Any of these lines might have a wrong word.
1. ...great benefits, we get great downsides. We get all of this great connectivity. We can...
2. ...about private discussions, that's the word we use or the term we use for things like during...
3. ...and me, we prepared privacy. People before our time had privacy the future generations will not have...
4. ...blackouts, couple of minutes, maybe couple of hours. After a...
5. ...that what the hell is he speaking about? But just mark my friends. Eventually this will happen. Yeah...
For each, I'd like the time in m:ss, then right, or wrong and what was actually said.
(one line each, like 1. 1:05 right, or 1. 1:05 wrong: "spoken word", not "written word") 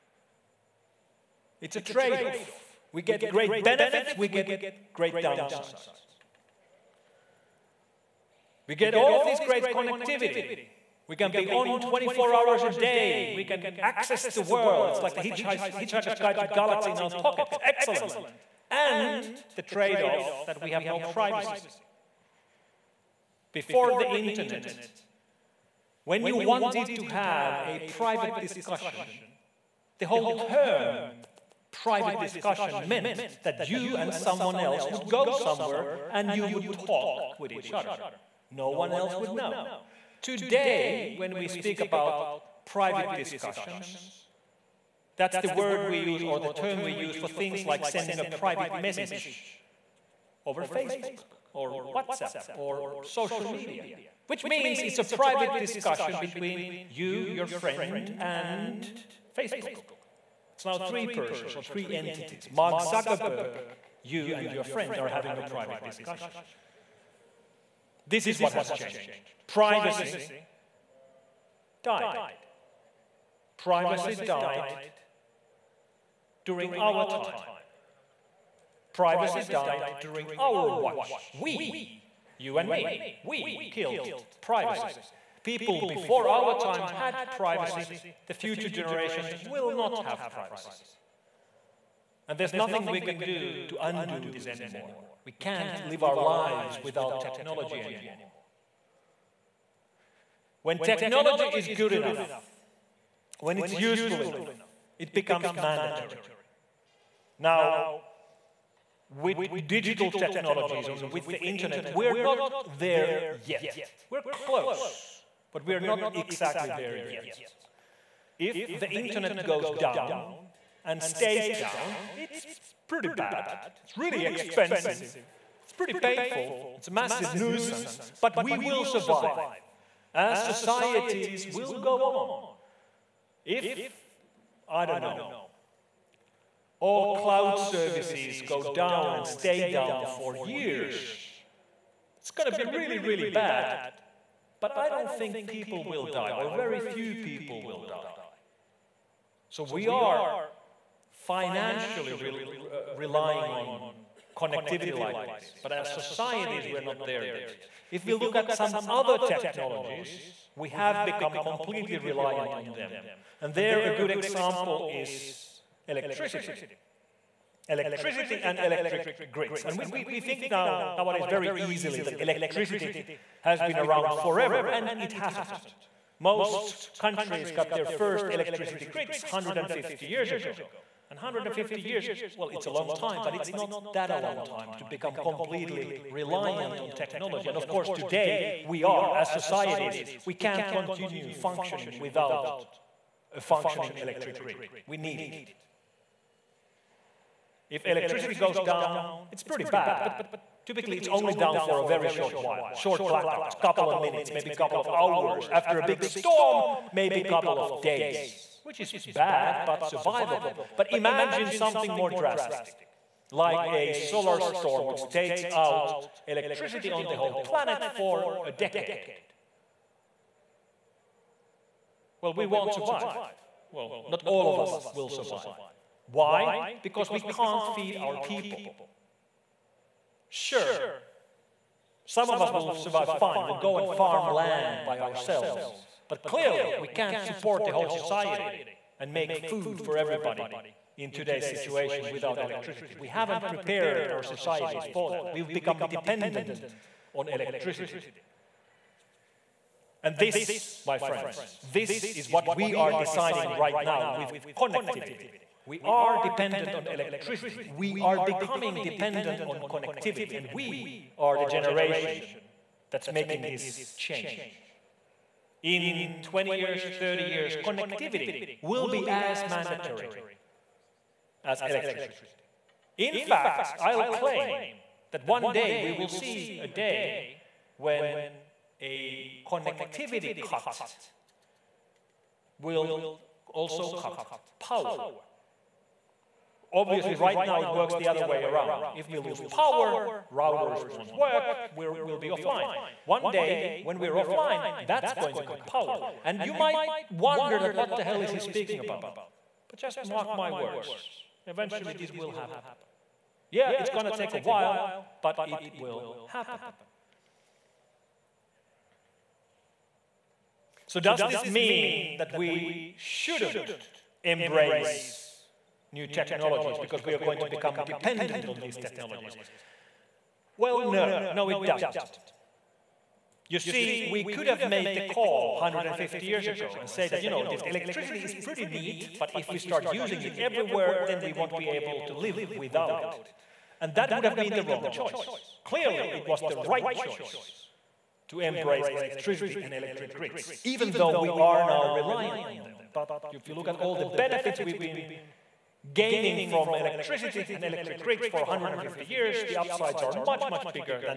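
1. 0:03 right
2. 0:41 wrong: "sending", not "during"
3. 1:22 wrong: "killed", not "prepared"
4. 3:23 right
5. 4:57 wrong: "words", not "friends".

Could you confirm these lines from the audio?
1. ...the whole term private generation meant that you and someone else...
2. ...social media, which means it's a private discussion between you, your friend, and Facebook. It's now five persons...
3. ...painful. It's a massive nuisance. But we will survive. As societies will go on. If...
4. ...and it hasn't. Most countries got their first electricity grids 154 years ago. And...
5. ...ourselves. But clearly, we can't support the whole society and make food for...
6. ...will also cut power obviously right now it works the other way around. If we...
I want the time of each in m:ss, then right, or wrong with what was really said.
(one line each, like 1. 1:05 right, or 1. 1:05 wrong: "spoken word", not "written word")
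1. 0:29 wrong: "discussion", not "generation"
2. 0:53 wrong: "three", not "five"
3. 2:05 right
4. 2:54 wrong: "150", not "154"
5. 3:54 right
6. 4:42 right.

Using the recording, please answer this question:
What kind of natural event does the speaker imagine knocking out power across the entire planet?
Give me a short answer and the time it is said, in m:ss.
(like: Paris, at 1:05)
solar storm, at 3:33.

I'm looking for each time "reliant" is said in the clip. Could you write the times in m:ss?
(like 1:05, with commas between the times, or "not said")
2:41, 3:06, 5:41.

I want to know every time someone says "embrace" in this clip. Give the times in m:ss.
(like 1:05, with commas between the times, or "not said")
5:14, 5:38.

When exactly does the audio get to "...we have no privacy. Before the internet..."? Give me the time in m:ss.
0:20.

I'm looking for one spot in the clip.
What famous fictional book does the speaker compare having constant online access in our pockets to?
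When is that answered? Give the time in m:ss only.
0:15.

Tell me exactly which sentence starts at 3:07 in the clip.
And of course, today we are, as societies, we can't continue functioning without a functioning electric grid.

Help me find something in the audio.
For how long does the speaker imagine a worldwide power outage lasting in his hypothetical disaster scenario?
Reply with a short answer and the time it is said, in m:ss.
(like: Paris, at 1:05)
a decade, at 3:38.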